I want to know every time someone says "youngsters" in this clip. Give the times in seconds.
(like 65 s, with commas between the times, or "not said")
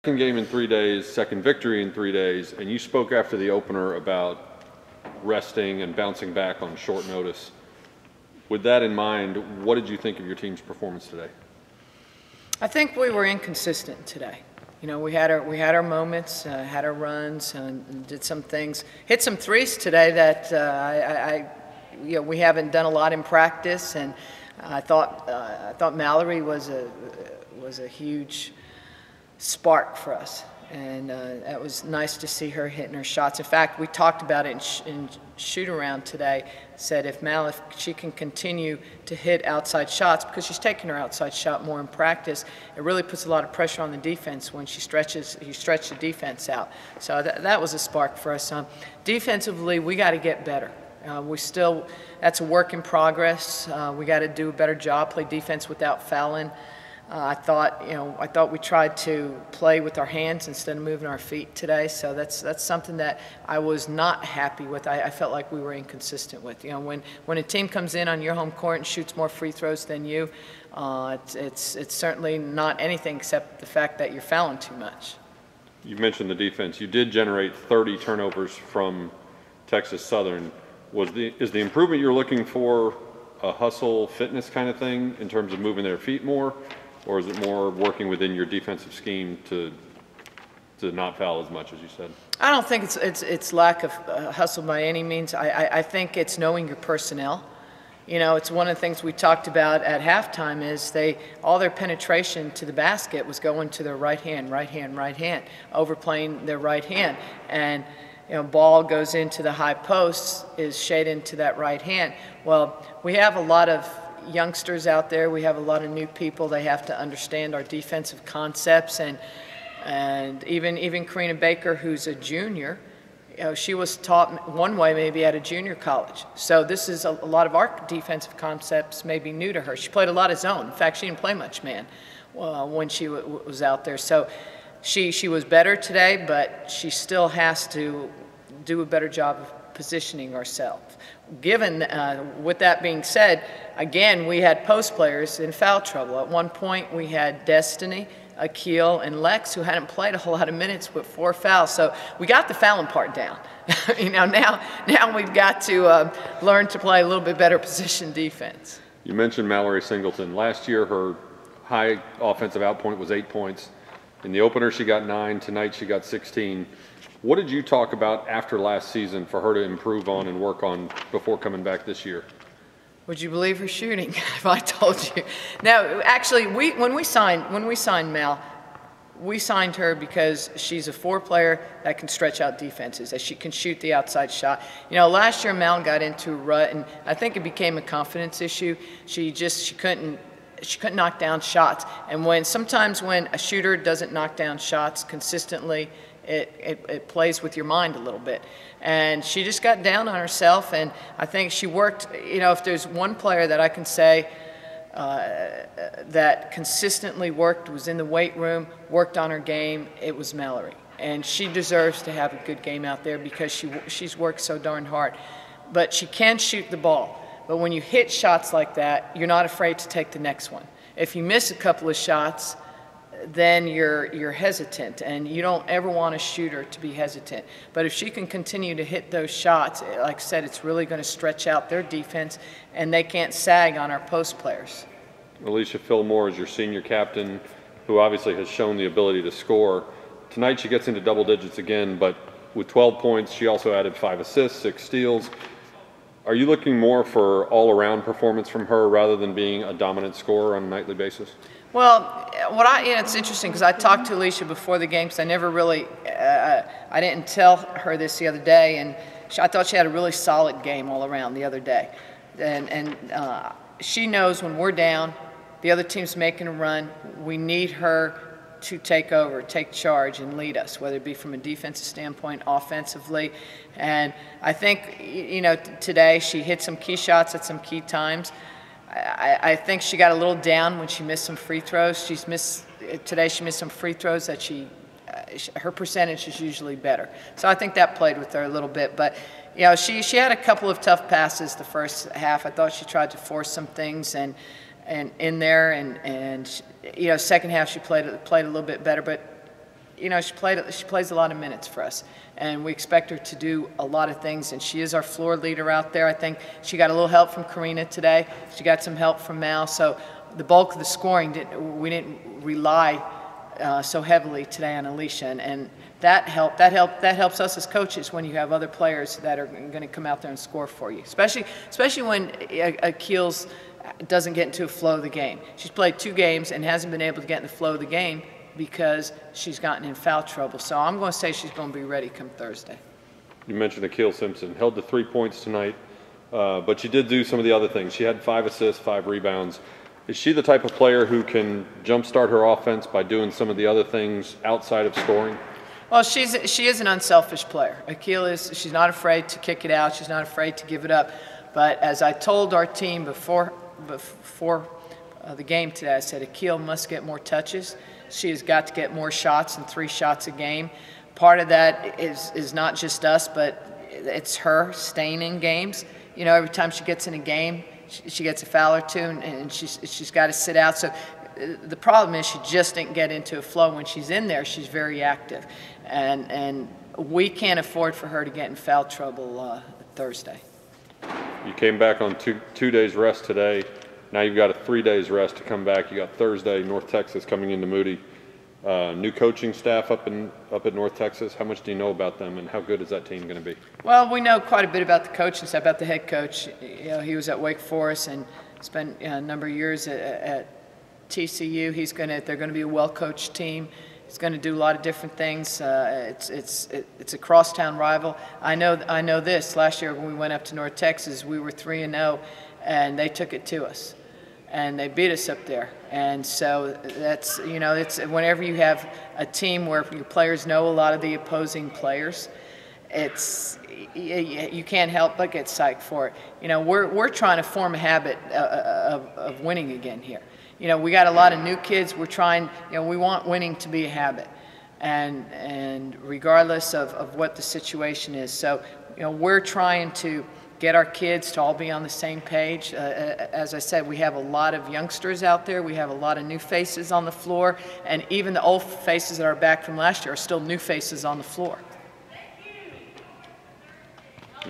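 114 s, 444 s.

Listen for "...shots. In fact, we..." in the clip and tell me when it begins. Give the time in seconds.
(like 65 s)
33 s.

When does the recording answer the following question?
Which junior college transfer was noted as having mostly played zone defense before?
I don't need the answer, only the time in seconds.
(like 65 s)
121 s.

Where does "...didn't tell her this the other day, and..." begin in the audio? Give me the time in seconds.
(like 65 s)
256 s.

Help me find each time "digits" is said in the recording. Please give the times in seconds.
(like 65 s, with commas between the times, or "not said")
241 s.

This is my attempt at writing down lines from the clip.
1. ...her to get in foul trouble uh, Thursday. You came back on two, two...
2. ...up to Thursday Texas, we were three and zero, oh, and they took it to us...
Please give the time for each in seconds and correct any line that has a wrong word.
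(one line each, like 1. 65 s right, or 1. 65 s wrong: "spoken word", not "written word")
1. 378 s right
2. 410 s wrong: "North", not "Thursday".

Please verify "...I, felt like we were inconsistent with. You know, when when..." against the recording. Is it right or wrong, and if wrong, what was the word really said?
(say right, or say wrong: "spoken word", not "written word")
right.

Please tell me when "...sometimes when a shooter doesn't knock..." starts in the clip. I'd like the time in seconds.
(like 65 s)
192 s.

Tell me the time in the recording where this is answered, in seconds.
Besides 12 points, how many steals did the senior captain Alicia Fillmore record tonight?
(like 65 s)
244 s.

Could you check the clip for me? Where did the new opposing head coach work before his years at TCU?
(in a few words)
Wake Forest.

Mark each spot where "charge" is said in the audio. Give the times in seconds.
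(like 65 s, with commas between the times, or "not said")
269 s.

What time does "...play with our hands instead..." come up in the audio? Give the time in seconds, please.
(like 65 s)
59 s.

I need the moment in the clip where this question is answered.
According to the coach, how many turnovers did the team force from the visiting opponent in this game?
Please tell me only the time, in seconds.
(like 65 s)
77 s.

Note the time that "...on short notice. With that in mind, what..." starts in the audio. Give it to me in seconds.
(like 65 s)
6 s.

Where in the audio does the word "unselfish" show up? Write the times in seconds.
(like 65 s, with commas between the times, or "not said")
346 s.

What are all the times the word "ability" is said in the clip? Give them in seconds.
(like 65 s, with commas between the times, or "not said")
238 s.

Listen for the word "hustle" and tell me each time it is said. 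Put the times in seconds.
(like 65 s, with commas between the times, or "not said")
83 s, 94 s.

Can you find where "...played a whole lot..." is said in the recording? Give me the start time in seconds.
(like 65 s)
149 s.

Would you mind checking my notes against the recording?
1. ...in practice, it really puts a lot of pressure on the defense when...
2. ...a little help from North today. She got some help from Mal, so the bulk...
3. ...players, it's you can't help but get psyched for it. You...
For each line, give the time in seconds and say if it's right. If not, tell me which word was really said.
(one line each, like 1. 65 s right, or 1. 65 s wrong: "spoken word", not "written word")
1. 41 s right
2. 306 s wrong: "Karina", not "North"
3. 421 s right.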